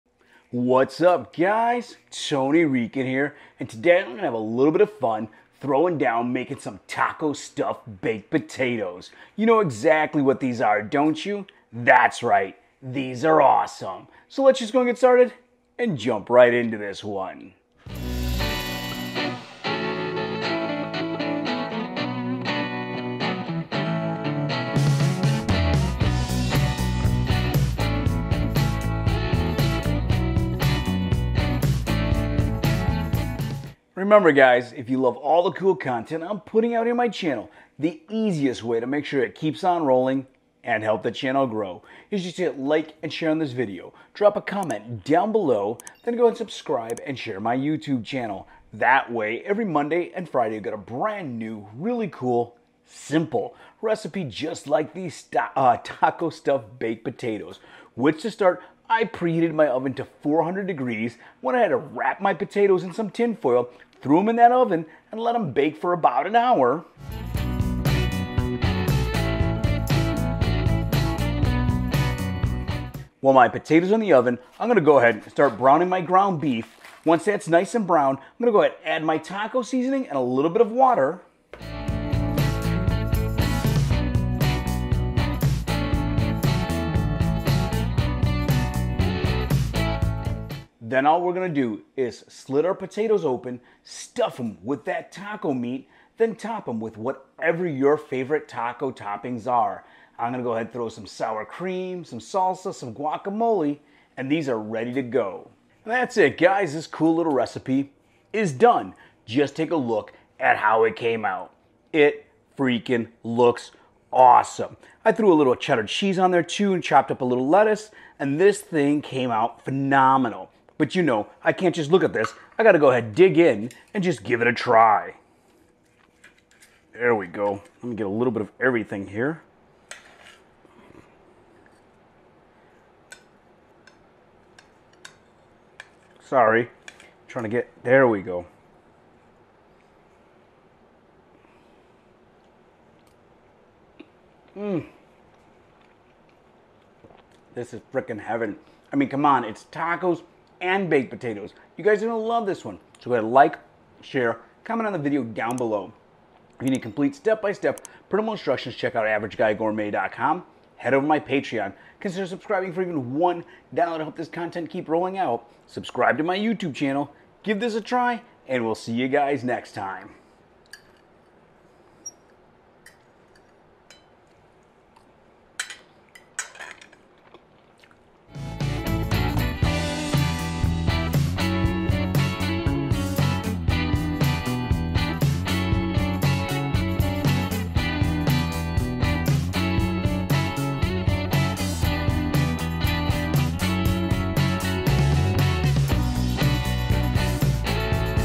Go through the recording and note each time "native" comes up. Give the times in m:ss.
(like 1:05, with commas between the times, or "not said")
not said.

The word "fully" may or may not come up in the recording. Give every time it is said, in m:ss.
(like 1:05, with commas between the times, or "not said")
not said.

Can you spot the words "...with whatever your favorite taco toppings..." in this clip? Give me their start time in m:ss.
1:36.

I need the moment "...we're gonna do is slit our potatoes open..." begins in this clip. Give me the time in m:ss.
1:31.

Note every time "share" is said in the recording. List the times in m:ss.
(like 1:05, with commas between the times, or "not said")
0:43, 0:47, 2:34.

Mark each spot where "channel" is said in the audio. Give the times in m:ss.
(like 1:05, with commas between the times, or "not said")
0:37, 0:41, 0:48, 2:46.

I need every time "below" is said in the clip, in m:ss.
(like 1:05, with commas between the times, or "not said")
0:45, 2:35.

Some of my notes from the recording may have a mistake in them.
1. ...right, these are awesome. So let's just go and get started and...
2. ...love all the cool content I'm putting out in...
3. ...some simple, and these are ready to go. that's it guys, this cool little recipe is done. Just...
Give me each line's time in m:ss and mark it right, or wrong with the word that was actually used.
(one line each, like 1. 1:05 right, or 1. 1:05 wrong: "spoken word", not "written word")
1. 0:12 right
2. 0:34 right
3. 1:42 wrong: "guacamole", not "simple".